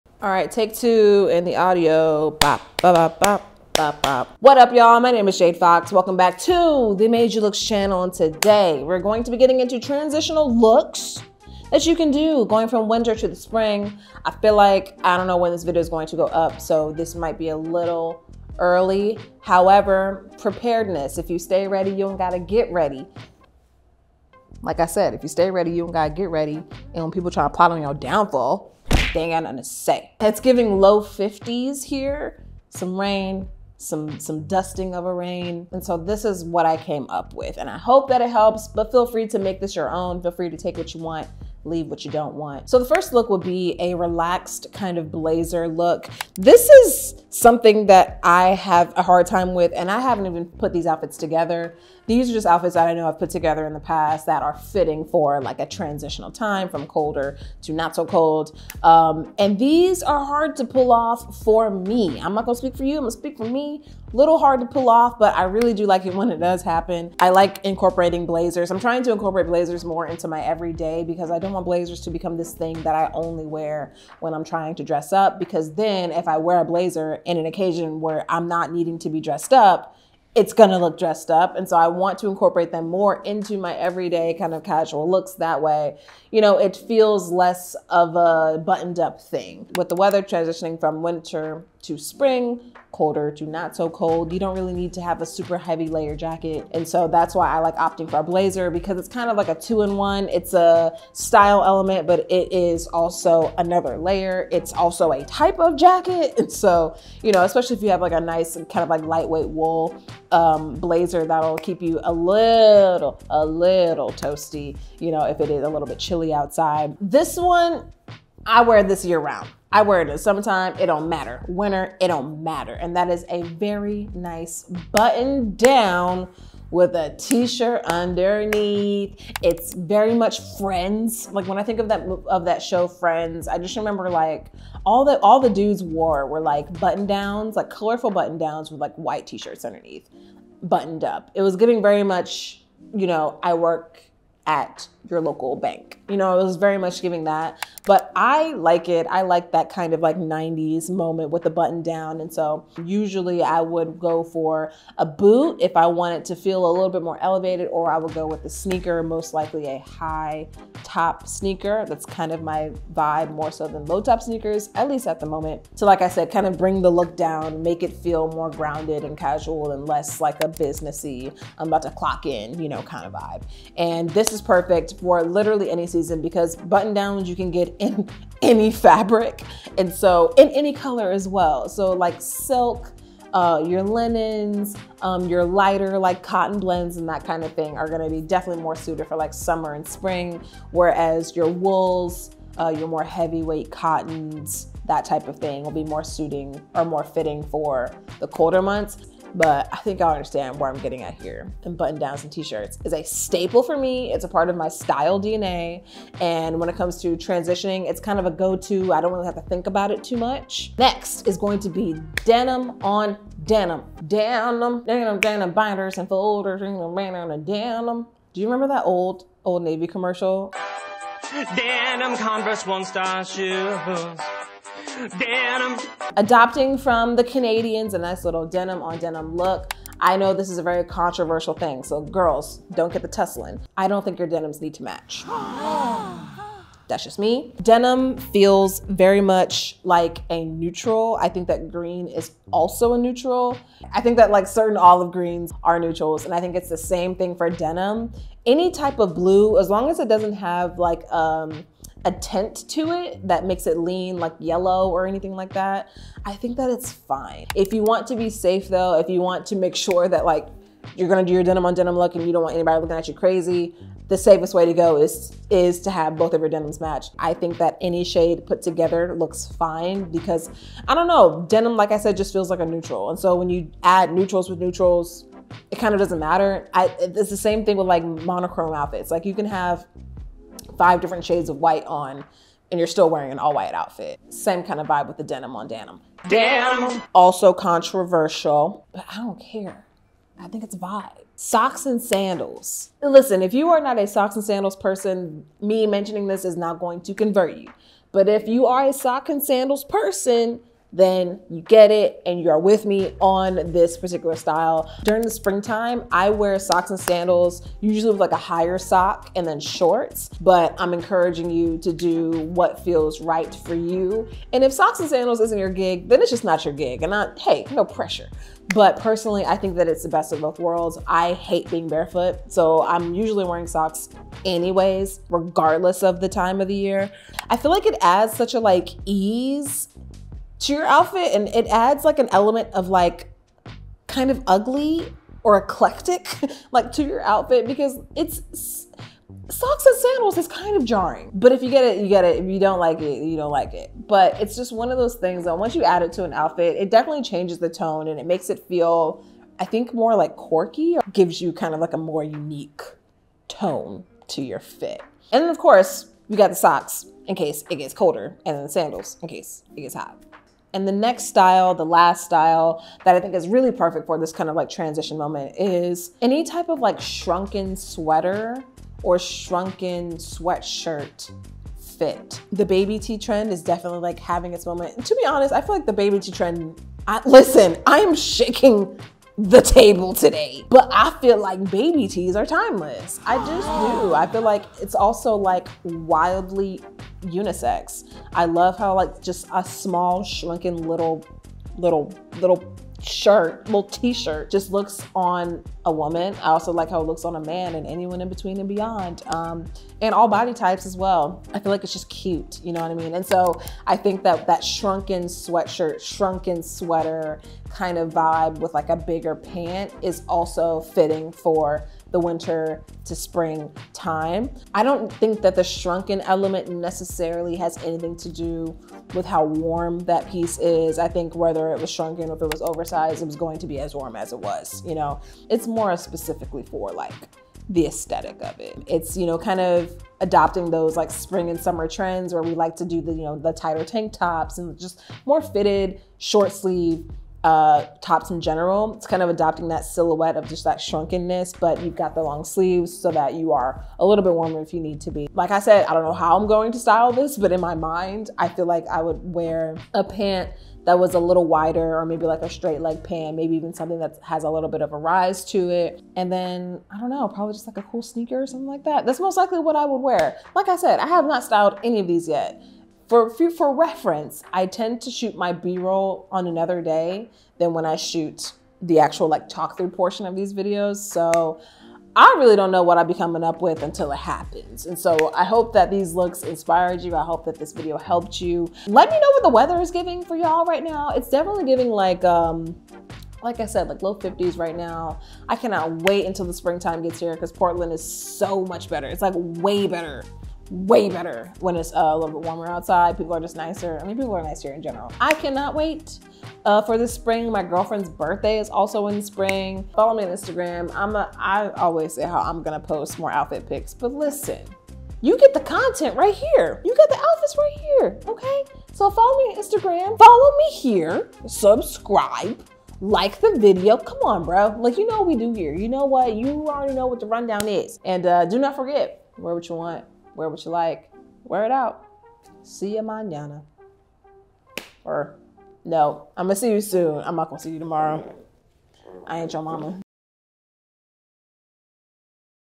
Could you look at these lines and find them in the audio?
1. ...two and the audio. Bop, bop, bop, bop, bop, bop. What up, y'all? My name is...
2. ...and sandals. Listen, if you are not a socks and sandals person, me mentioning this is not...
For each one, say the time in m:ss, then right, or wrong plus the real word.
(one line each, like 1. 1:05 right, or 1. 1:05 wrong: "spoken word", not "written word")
1. 0:00 right
2. 4:51 right.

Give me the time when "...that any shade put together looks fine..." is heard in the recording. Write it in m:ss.
4:27.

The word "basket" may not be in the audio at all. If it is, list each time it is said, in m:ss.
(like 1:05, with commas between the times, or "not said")
not said.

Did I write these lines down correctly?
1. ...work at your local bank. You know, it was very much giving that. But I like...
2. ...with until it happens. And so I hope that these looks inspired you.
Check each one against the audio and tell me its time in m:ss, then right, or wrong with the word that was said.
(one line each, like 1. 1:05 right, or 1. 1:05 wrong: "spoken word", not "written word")
1. 2:23 right
2. 7:53 right.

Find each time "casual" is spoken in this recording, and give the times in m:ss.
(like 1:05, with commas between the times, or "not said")
1:24, 2:49.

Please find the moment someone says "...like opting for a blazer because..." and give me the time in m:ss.
1:37.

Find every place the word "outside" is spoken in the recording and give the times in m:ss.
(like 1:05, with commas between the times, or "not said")
1:56, 8:12.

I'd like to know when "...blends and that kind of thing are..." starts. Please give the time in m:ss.
3:06.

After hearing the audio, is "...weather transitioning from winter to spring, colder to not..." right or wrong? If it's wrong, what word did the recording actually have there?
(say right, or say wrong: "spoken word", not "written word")
right.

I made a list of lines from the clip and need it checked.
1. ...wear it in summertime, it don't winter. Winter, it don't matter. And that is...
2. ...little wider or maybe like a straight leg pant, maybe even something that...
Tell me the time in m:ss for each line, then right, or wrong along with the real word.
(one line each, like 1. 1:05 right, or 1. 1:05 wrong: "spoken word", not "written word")
1. 1:59 wrong: "matter", not "winter"
2. 7:31 right.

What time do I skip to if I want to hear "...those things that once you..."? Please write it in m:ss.
5:44.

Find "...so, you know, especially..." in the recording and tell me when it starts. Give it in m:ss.
1:46.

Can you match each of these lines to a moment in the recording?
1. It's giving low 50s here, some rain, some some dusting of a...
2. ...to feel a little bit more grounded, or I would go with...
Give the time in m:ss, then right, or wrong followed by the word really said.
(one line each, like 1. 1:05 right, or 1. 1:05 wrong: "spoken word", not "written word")
1. 0:30 right
2. 2:36 wrong: "elevated", not "grounded".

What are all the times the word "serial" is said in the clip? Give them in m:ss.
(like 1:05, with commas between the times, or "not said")
not said.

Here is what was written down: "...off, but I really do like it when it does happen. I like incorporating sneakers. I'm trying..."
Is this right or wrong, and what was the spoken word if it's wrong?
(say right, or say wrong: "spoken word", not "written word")
wrong: "blazers", not "sneakers".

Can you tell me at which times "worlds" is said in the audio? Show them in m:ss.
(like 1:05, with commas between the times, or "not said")
5:20.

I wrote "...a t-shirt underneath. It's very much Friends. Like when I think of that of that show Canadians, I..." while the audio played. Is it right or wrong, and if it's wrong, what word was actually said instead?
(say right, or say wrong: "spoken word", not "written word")
wrong: "Friends", not "Canadians".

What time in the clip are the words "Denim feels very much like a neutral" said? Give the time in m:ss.
3:57.